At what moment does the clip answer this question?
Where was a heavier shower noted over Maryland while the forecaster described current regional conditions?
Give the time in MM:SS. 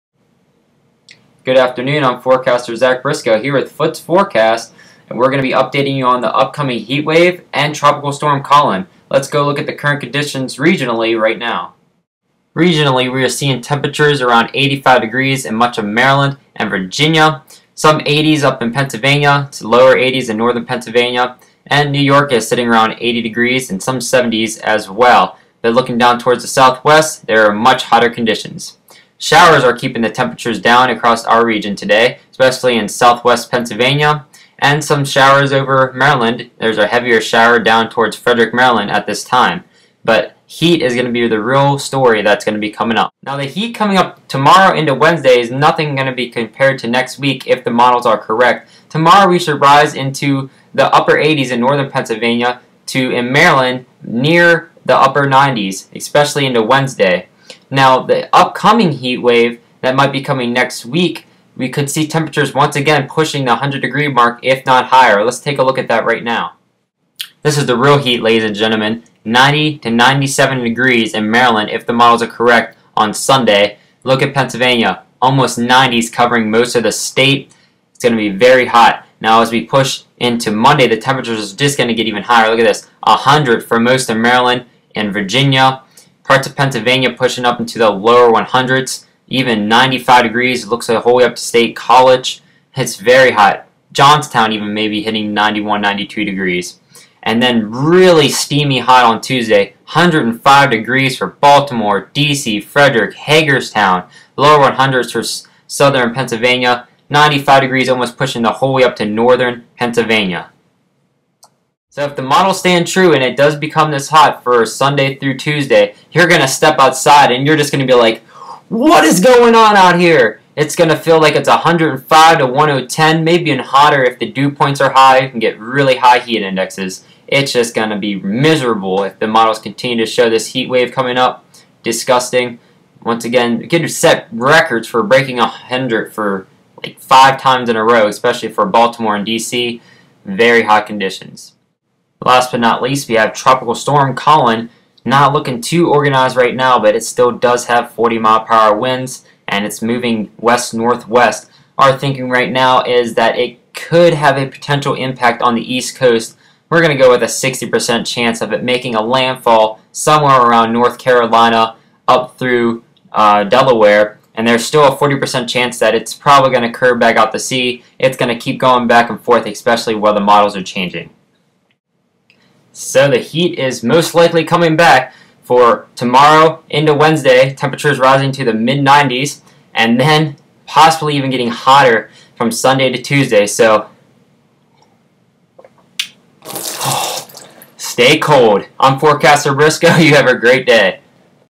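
00:38.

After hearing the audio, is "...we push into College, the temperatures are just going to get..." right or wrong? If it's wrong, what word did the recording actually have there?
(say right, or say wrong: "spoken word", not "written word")
wrong: "Monday", not "College".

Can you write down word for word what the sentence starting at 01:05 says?
Let's take a look at that right now.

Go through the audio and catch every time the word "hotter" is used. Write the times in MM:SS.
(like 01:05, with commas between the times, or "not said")
00:27, 02:03, 03:01.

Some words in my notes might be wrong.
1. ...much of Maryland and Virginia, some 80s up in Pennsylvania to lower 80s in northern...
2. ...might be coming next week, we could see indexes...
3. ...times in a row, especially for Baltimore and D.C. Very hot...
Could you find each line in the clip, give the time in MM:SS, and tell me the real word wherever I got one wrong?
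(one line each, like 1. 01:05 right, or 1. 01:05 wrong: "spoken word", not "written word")
1. 00:15 right
2. 00:59 wrong: "temperatures", not "indexes"
3. 02:17 right.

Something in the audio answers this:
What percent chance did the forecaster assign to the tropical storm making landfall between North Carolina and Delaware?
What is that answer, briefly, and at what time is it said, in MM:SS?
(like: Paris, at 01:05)
60%, at 02:37.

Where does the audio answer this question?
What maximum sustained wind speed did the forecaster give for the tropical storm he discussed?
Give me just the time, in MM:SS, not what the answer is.
02:27.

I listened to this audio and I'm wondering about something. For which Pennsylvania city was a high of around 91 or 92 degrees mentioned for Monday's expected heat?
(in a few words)
Johnstown.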